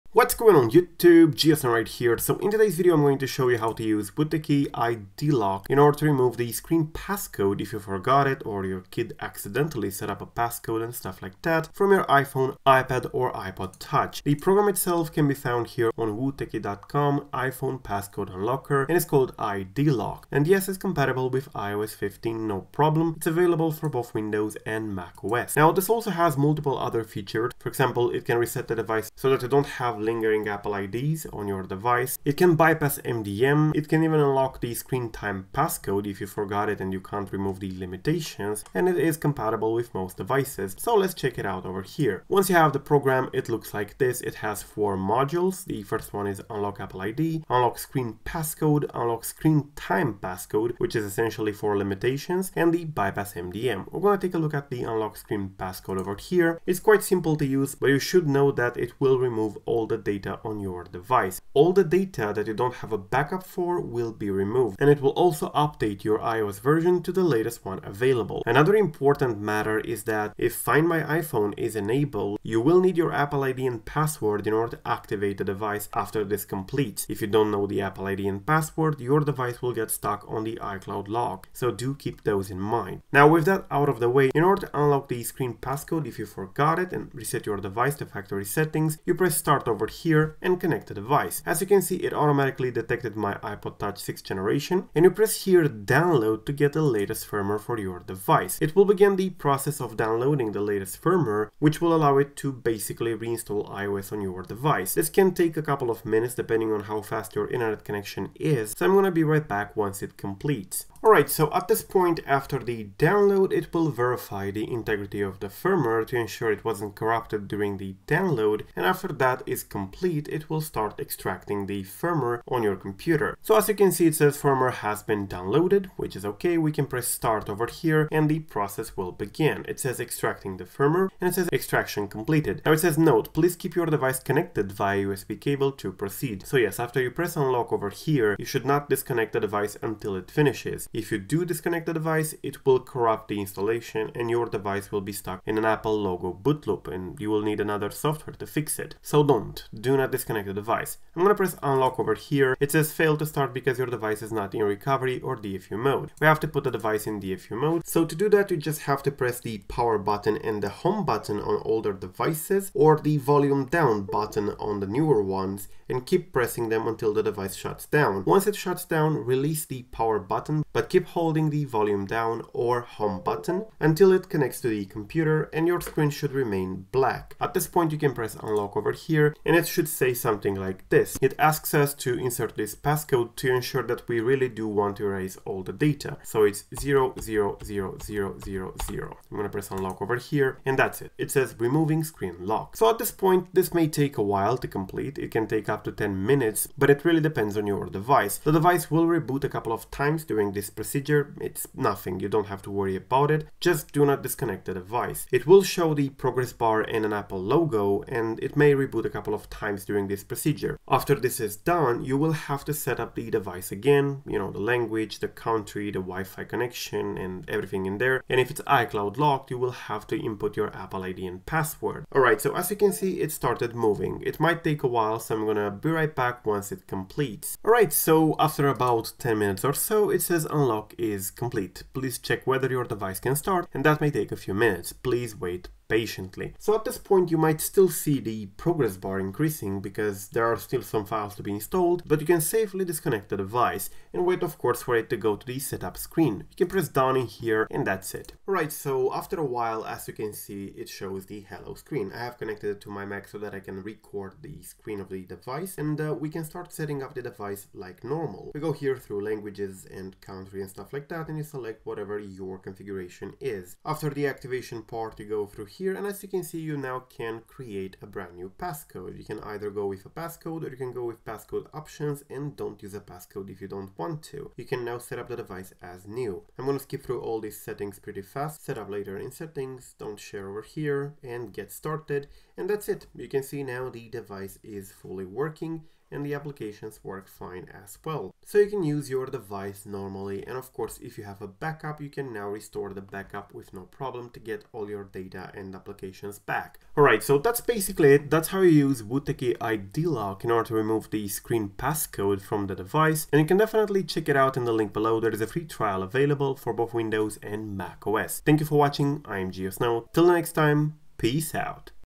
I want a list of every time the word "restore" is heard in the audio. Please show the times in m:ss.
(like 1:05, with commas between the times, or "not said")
4:52.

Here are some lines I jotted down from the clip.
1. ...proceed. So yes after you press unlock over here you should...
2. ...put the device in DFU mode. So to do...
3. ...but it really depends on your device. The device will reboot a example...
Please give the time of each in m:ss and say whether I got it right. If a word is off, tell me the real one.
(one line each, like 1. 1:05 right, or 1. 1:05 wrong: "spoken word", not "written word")
1. 2:15 right
2. 2:36 right
3. 3:16 wrong: "couple", not "example".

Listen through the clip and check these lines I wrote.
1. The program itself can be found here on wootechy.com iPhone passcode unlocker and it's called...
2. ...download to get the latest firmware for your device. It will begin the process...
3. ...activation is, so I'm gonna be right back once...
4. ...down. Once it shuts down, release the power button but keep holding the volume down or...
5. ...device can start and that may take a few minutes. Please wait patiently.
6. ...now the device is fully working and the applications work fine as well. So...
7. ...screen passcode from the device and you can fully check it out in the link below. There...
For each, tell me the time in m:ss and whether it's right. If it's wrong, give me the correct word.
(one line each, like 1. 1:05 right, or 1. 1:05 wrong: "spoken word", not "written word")
1. 0:14 right
2. 1:35 right
3. 1:47 wrong: "connection", not "activation"
4. 2:47 right
5. 3:52 right
6. 4:43 right
7. 5:01 wrong: "definitely", not "fully".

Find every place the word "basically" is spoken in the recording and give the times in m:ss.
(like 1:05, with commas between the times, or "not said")
1:42, 4:57.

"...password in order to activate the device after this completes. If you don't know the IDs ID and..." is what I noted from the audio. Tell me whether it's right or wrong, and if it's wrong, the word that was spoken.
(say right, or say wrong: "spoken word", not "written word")
wrong: "Apple", not "IDs".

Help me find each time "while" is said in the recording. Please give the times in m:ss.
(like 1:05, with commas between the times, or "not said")
3:14, 3:44, 4:09.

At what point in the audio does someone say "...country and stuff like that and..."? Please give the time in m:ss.
4:20.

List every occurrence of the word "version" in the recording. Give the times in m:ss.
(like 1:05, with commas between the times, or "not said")
1:06.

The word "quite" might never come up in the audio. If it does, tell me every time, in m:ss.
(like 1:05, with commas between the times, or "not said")
0:56.